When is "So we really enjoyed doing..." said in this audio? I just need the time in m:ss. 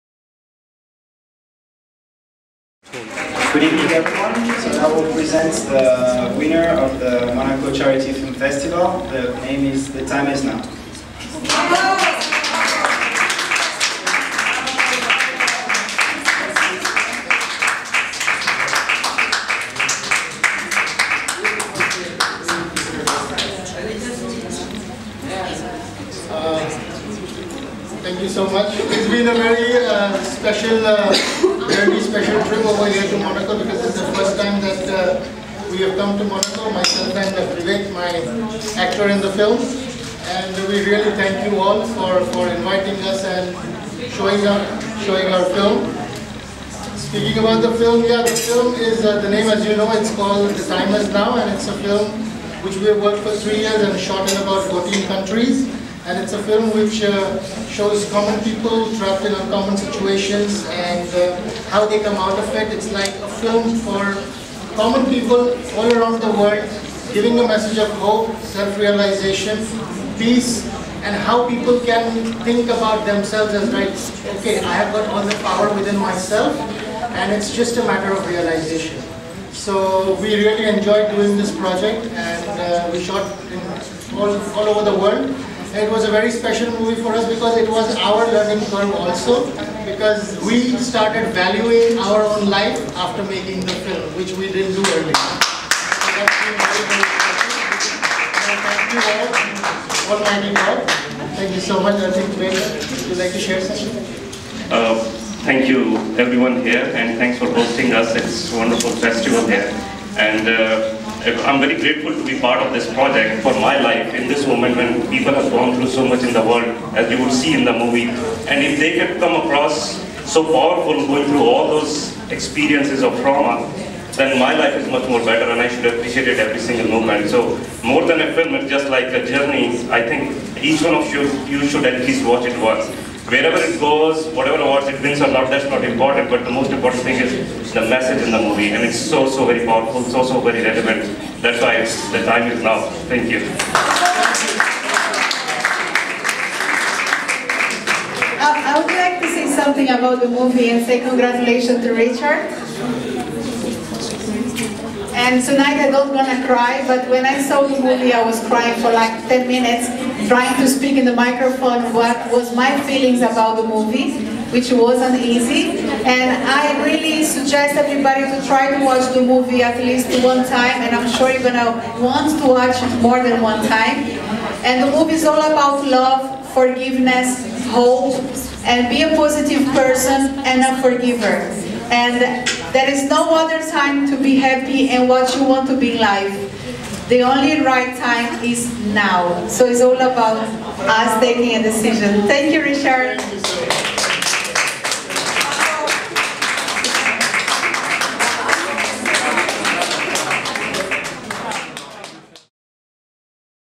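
1:19.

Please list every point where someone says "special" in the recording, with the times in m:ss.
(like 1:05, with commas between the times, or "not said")
0:30, 1:26.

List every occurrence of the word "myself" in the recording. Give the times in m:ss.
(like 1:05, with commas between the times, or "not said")
0:36, 1:15.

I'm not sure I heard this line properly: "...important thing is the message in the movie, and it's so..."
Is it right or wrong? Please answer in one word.
right.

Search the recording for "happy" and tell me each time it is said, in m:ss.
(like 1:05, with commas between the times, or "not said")
3:04.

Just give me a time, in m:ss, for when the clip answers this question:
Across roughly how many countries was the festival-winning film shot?
0:54.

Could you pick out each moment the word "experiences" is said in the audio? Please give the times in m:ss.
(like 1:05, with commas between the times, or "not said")
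2:02.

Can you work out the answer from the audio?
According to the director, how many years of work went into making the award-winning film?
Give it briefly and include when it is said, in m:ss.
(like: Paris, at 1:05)
3, at 0:53.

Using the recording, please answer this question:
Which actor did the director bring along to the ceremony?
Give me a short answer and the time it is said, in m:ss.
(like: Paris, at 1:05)
Vivek, at 0:37.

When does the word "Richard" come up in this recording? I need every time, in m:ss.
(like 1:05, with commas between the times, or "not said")
2:31, 3:12.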